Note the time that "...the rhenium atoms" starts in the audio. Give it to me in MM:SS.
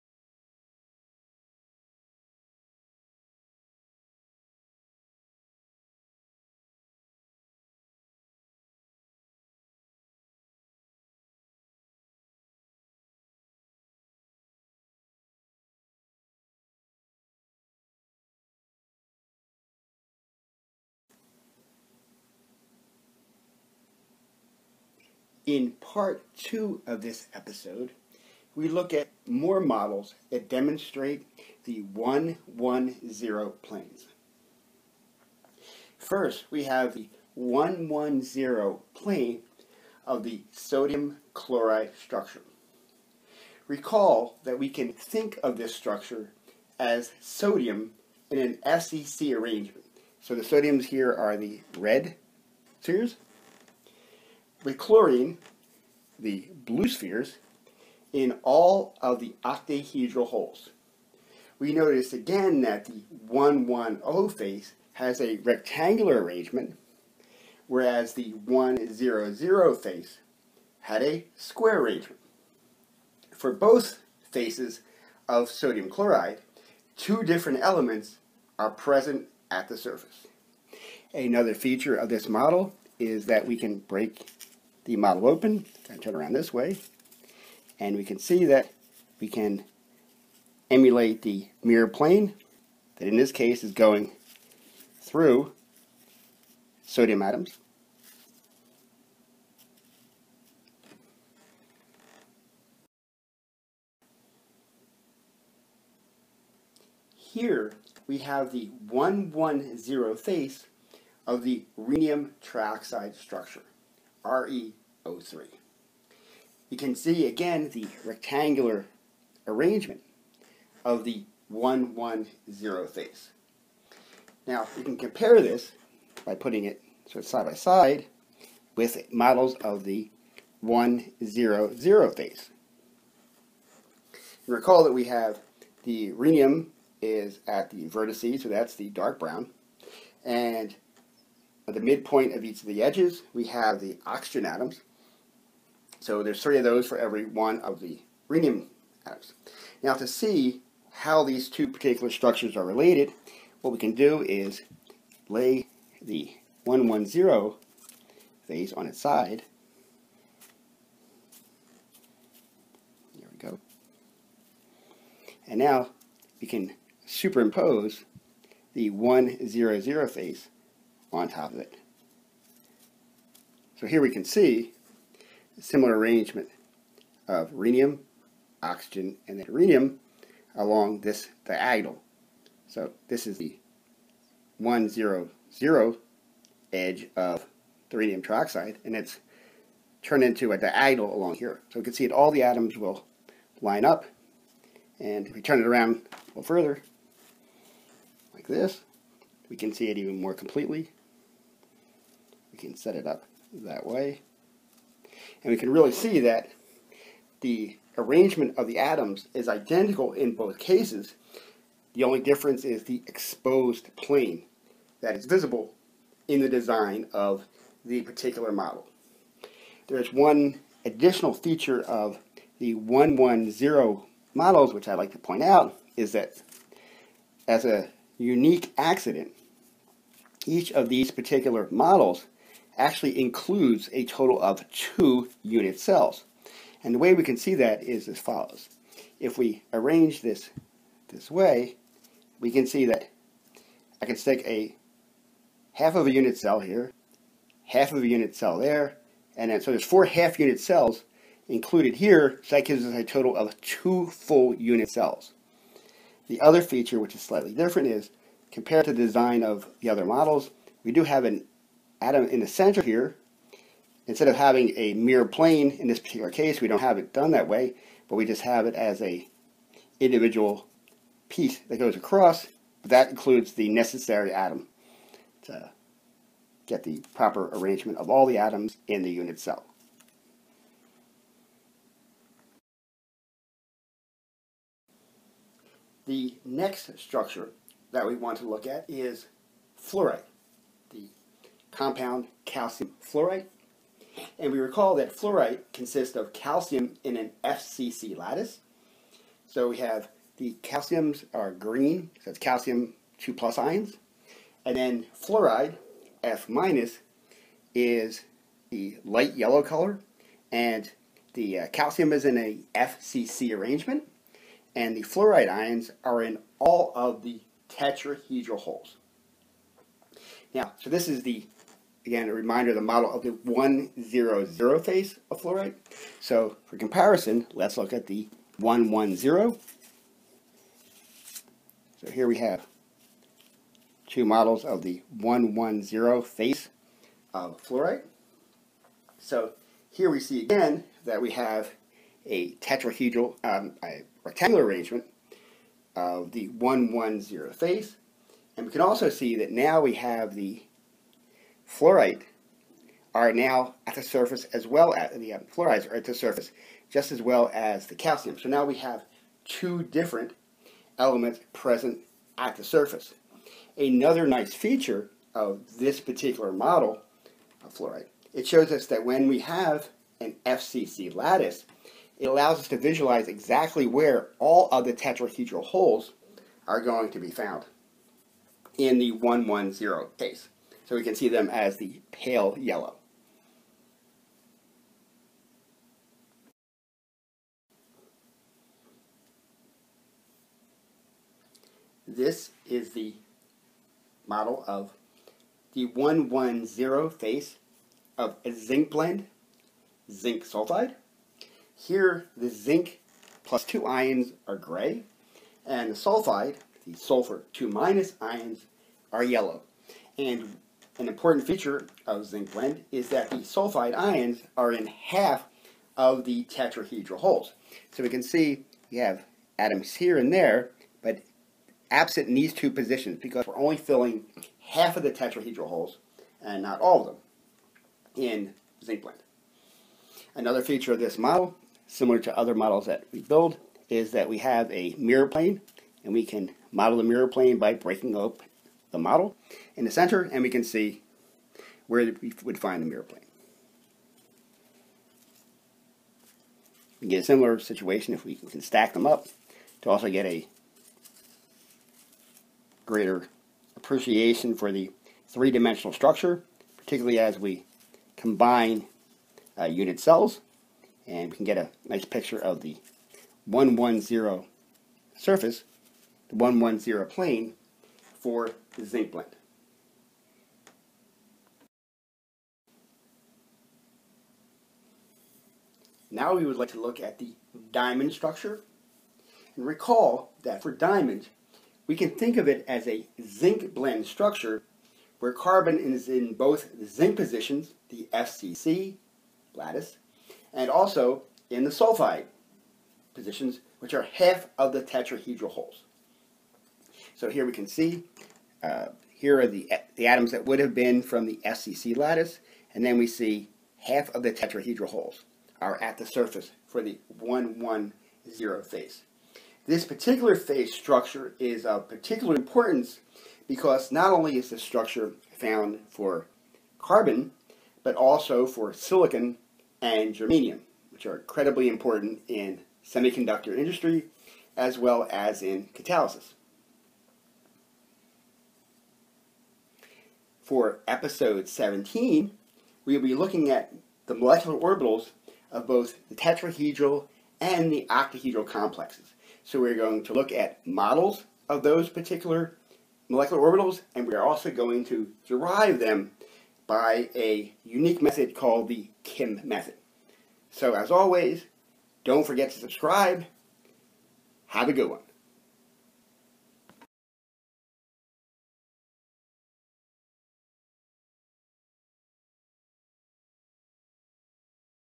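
02:27.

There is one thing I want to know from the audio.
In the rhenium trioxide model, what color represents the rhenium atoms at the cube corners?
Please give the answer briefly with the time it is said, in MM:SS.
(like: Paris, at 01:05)
Dark brown, at 02:18.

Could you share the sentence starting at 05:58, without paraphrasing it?
So now we have two different elements present at the surface.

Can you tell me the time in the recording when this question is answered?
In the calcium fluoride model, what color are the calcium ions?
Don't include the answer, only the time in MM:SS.
05:01.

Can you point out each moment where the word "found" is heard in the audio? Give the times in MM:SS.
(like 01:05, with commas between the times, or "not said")
06:17, 08:35.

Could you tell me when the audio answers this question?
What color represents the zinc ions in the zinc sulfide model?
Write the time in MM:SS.
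06:44.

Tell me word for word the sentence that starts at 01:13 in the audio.
For both faces of sodium chloride, two different elements are present at the surface.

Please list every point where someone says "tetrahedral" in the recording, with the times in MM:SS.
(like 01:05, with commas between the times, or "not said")
05:17, 05:42, 06:14, 06:56, 07:05, 08:14, 08:24, 08:56.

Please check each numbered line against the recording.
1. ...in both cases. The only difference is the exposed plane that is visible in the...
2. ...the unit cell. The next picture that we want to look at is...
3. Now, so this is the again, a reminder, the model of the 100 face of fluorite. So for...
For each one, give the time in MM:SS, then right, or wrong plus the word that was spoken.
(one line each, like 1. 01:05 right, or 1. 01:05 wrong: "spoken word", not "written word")
1. 03:30 right
2. 04:39 wrong: "structure", not "picture"
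3. 05:20 right.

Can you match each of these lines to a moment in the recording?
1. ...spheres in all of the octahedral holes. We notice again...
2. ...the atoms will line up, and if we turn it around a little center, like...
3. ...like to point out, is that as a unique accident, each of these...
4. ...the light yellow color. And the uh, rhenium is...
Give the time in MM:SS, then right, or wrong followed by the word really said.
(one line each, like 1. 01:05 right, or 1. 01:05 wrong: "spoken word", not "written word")
1. 00:56 right
2. 03:12 wrong: "further", not "center"
3. 03:44 right
4. 05:08 wrong: "calcium", not "rhenium".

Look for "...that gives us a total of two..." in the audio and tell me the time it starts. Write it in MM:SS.
04:12.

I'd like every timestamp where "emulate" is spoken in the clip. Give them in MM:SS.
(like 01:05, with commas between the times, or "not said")
01:30.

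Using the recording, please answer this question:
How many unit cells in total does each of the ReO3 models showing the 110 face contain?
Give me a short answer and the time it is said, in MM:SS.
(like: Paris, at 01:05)
2, at 03:54.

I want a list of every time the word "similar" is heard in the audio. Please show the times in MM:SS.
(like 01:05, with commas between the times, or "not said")
02:55, 07:11, 07:27.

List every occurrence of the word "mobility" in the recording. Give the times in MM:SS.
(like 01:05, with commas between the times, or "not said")
not said.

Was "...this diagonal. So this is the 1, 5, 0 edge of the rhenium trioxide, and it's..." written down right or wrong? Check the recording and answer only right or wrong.
wrong.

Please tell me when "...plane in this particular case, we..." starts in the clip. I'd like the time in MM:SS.
04:25.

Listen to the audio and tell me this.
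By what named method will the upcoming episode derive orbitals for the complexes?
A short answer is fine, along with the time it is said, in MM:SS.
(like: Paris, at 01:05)
Kim method, at 09:09.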